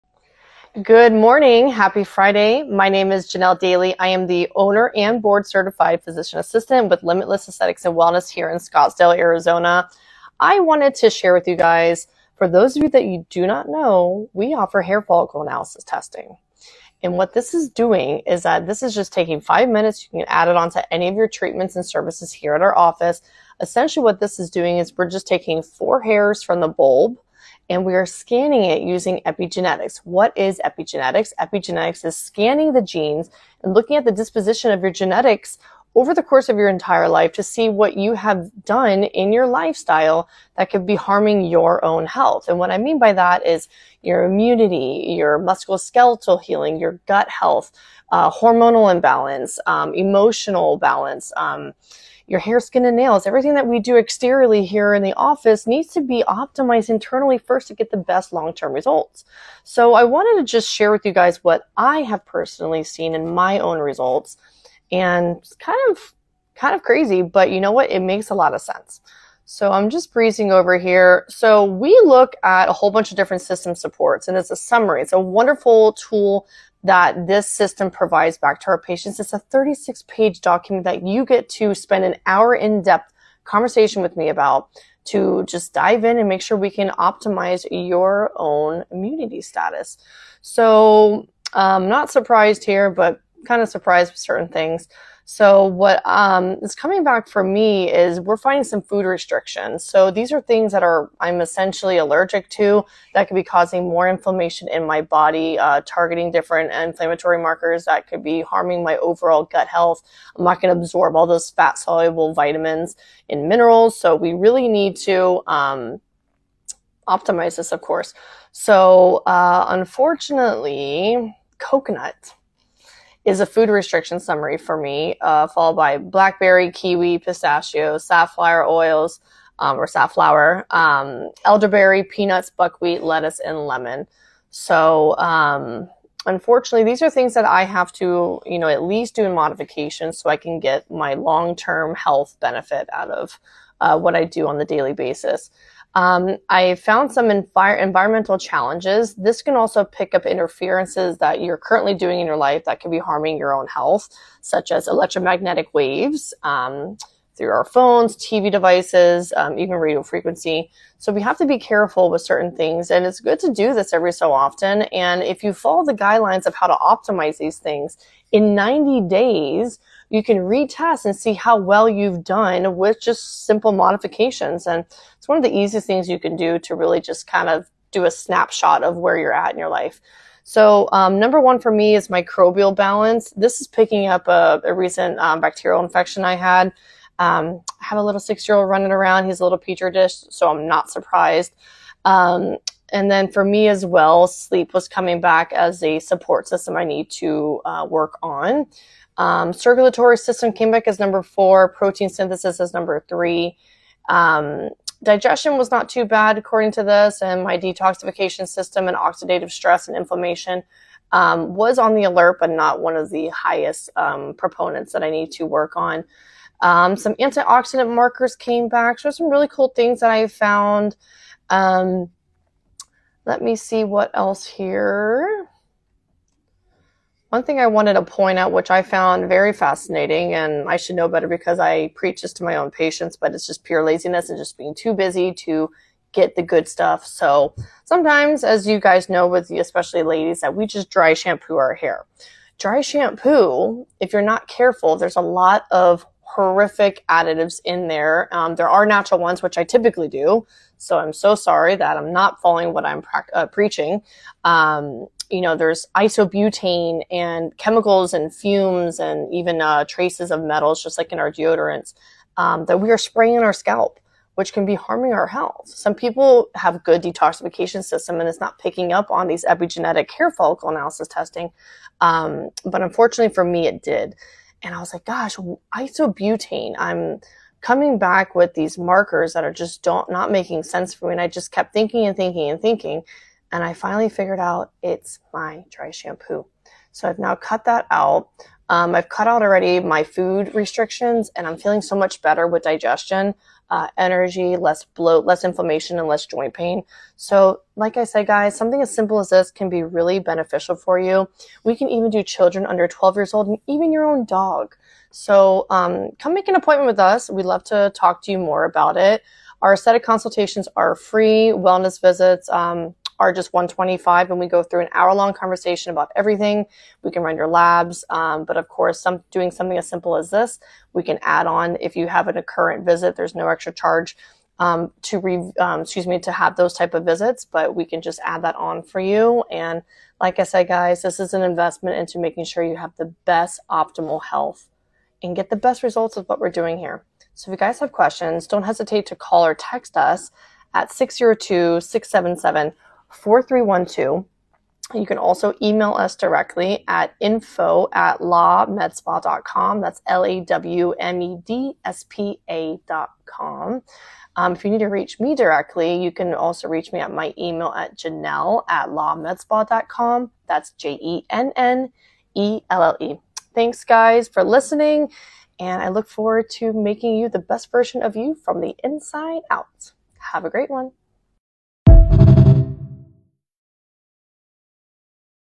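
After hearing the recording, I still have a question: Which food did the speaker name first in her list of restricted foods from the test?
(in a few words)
Coconut.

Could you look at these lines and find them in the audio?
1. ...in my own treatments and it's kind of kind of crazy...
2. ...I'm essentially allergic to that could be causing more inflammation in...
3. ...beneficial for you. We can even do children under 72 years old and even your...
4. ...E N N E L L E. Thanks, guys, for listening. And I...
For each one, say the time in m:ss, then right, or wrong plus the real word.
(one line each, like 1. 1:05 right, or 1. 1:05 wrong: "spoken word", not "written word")
1. 1:03 wrong: "results", not "treatments"
2. 1:41 right
3. 5:00 wrong: "12", not "72"
4. 6:01 right.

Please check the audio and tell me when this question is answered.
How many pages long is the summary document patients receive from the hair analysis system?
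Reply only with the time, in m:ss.
1:19.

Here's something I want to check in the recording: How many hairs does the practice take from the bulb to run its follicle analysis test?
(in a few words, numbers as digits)
4.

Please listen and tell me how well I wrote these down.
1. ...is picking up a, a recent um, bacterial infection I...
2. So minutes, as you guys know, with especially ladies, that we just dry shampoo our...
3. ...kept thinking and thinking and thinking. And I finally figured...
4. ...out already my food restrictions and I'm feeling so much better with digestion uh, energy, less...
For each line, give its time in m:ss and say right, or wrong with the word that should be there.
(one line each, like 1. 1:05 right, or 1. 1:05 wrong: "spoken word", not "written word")
1. 3:03 right
2. 3:57 wrong: "sometimes", not "minutes"
3. 4:41 right
4. 4:49 right.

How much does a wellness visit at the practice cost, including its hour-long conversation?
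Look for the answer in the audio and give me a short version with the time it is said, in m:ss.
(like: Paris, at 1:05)
$125, at 5:13.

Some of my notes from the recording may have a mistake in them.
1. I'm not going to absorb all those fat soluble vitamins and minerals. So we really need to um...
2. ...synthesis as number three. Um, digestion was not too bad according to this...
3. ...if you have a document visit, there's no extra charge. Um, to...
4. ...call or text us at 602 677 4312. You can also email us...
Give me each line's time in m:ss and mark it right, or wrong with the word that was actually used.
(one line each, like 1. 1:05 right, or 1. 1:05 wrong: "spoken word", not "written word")
1. 1:50 right
2. 3:22 right
3. 5:21 wrong: "current", not "document"
4. 5:39 right.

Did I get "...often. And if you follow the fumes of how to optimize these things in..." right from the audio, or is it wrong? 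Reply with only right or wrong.
wrong.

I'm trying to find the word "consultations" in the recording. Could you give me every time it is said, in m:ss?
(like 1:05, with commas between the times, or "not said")
5:10.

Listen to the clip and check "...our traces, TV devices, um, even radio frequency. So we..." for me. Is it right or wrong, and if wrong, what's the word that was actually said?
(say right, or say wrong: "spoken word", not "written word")
wrong: "phones", not "traces".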